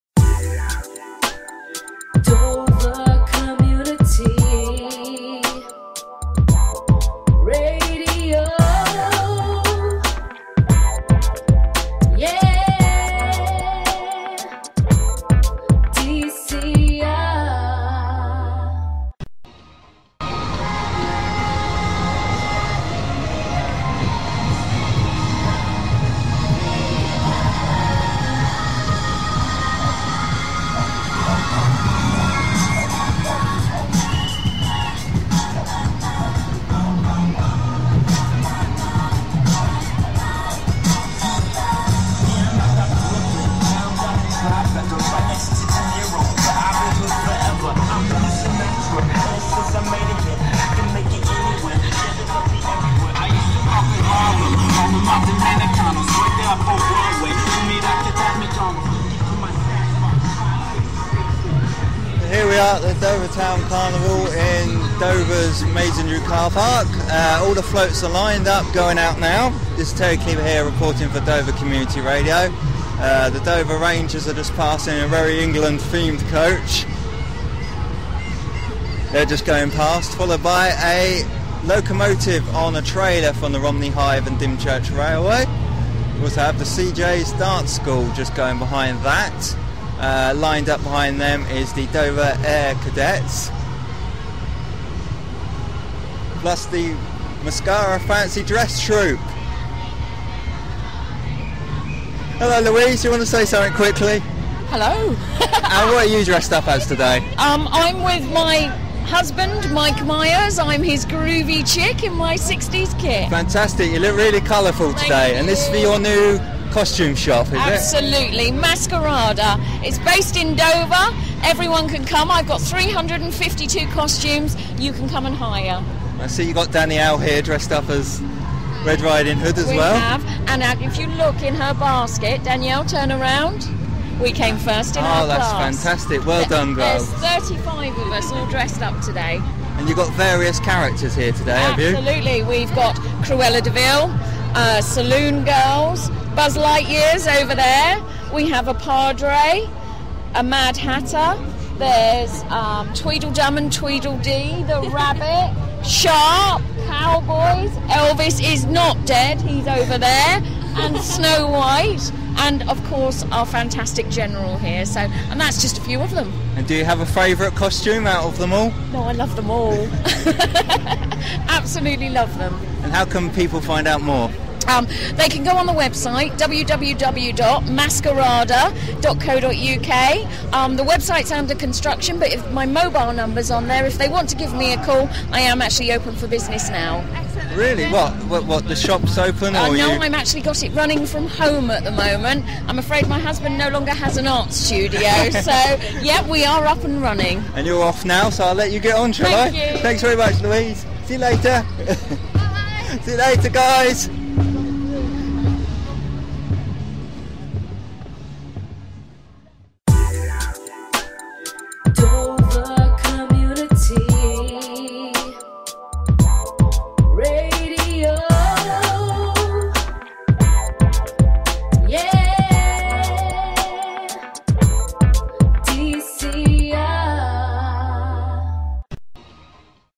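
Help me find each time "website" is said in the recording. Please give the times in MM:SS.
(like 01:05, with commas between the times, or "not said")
02:55, 03:00.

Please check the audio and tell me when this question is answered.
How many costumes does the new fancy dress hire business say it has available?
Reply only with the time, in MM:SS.
02:02.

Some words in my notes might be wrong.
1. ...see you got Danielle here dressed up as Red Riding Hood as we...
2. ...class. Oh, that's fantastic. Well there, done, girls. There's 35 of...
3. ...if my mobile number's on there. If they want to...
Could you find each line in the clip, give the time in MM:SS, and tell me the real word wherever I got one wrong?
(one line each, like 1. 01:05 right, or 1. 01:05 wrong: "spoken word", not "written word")
1. 02:06 right
2. 02:15 right
3. 03:02 right.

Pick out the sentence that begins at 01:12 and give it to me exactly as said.
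Uh, the Dover Rangers are just passing a very England themed coach.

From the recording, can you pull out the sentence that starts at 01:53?
Fantastic, you look really colourful today.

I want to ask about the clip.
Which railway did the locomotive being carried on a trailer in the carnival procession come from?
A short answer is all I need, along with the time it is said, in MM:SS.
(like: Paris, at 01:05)
Romney Hythe and Dymchurch Railway, at 01:23.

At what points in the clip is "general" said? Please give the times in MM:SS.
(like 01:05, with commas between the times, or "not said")
02:44.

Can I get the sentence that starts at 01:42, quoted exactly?
Hello Louise, you want to say something quickly?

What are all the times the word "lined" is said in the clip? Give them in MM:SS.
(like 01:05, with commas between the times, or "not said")
01:08, 01:30.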